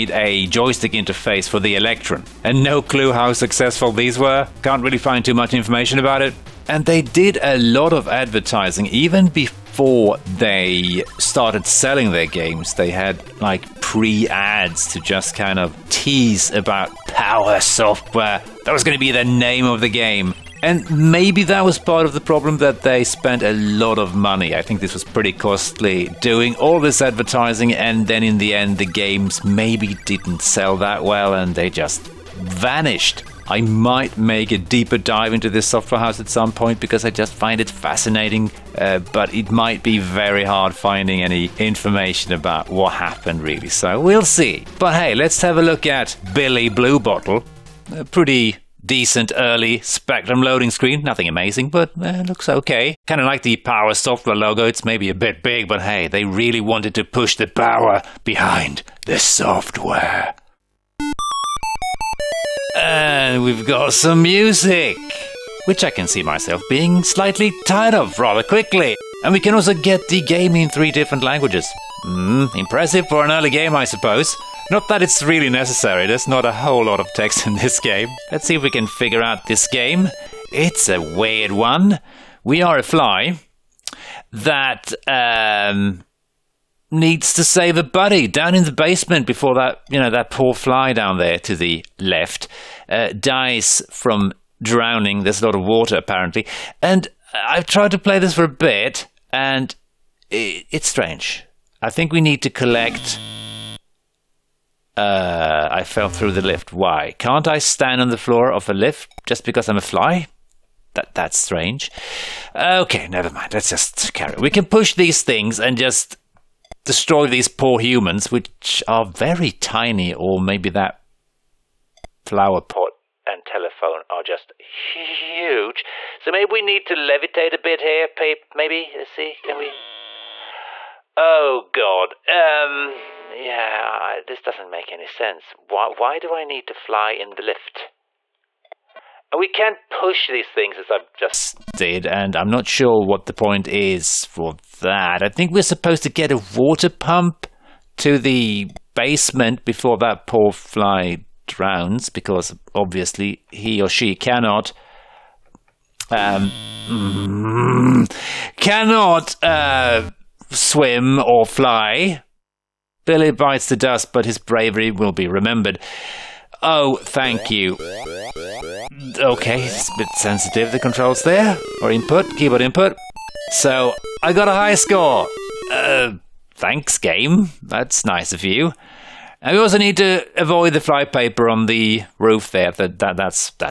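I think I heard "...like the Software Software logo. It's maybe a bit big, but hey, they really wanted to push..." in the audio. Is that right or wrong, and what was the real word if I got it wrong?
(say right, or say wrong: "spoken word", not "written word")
wrong: "Power", not "Software".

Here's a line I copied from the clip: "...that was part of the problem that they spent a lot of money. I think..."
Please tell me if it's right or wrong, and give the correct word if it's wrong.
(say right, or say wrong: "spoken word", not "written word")
right.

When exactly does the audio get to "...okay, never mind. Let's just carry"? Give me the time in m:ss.
1:52.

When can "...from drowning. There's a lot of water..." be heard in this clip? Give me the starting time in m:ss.
1:33.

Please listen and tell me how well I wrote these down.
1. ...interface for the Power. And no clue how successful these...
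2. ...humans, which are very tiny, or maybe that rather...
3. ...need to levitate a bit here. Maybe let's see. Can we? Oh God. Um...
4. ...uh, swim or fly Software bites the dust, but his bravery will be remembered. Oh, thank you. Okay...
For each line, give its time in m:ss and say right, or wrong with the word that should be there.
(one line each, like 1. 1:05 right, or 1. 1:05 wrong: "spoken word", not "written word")
1. 0:00 wrong: "Electron", not "Power"
2. 1:57 wrong: "flower", not "rather"
3. 2:06 right
4. 2:39 wrong: "Billy", not "Software".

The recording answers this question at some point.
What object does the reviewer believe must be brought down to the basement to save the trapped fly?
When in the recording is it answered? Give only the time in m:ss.
2:26.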